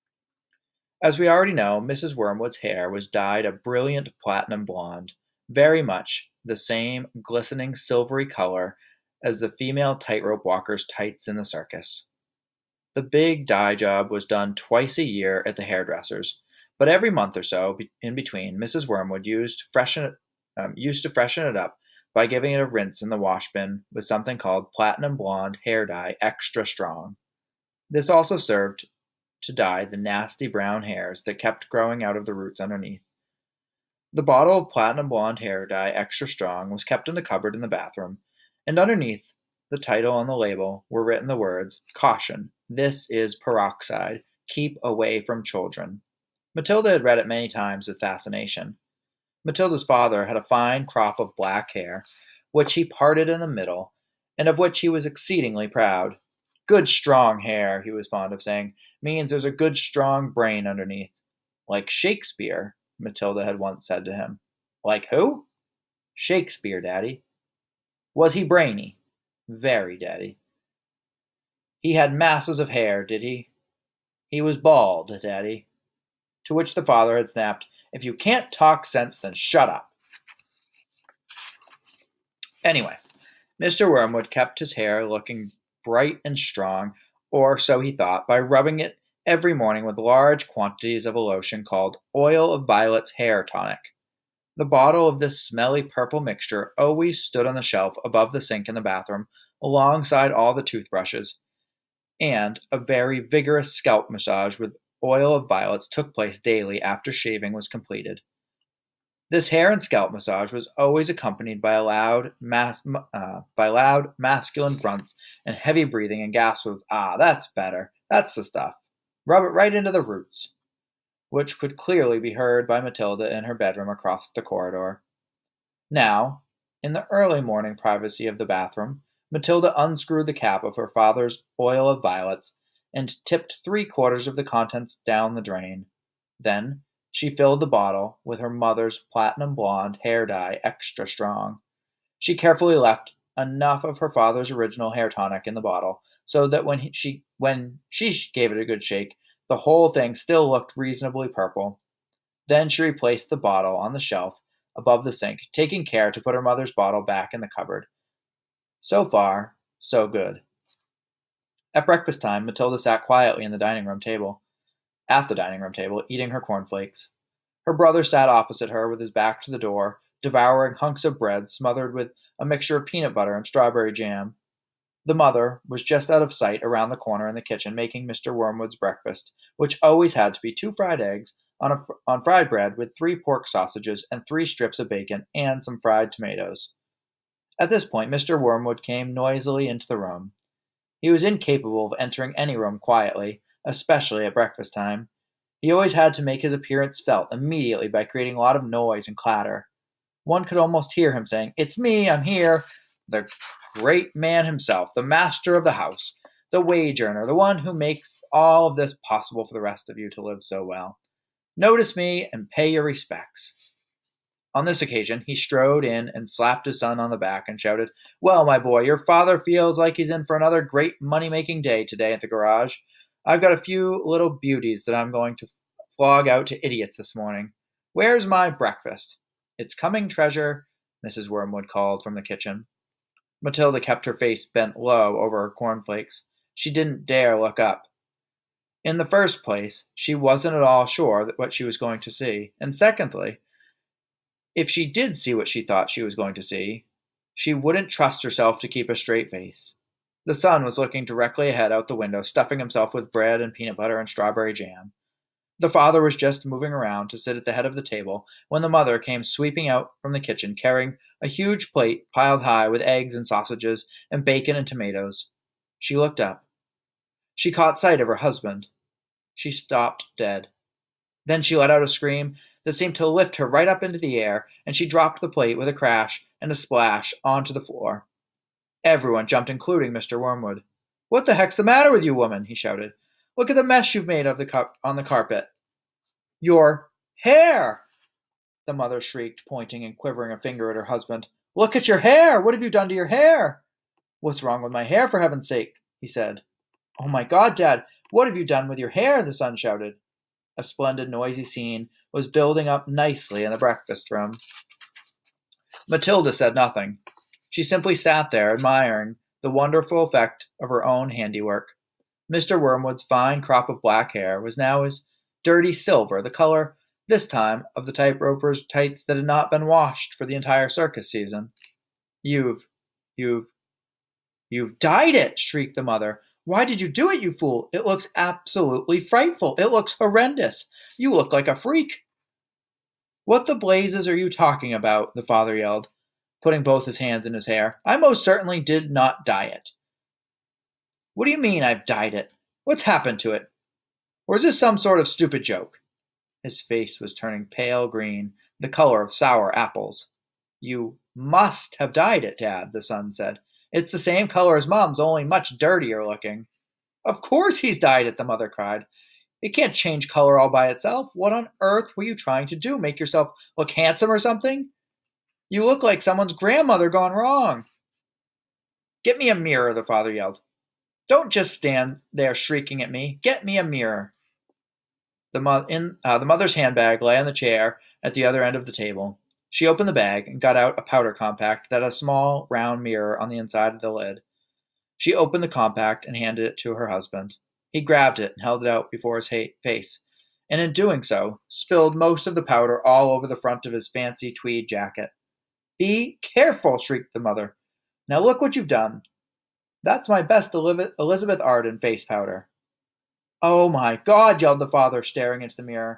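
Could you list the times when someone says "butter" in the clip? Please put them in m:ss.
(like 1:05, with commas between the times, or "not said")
2:53, 4:13.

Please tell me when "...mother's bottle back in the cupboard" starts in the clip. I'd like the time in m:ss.
2:36.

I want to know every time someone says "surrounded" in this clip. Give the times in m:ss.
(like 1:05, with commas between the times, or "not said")
not said.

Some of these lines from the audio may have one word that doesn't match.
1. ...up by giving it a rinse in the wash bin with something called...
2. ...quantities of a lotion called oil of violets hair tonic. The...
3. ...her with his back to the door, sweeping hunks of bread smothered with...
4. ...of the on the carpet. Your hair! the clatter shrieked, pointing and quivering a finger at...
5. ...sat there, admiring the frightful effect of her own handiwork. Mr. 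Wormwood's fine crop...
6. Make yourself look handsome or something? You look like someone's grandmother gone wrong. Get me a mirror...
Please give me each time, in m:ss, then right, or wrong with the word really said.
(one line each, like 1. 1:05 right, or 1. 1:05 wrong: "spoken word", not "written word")
1. 0:21 right
2. 1:30 right
3. 2:48 wrong: "devouring", not "sweeping"
4. 4:44 wrong: "mother", not "clatter"
5. 5:07 wrong: "wonderful", not "frightful"
6. 6:02 right.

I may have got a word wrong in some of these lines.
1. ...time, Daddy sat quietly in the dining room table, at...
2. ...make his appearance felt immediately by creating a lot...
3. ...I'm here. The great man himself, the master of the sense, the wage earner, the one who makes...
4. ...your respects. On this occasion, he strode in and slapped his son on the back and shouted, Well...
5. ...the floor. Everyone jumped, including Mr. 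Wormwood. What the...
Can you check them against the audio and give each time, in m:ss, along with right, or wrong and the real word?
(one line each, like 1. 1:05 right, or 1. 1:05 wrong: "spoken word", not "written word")
1. 2:42 wrong: "Matilda", not "Daddy"
2. 3:16 right
3. 3:22 wrong: "house", not "sense"
4. 3:32 right
5. 4:37 right.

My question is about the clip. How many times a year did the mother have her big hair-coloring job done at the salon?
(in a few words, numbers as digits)
twice.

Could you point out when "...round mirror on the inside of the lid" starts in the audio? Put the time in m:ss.
6:22.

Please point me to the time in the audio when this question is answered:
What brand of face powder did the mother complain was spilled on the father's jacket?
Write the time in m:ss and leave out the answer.
6:40.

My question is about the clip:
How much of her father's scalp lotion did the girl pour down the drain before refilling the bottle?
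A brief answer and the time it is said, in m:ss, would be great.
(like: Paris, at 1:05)
three quarters, at 2:13.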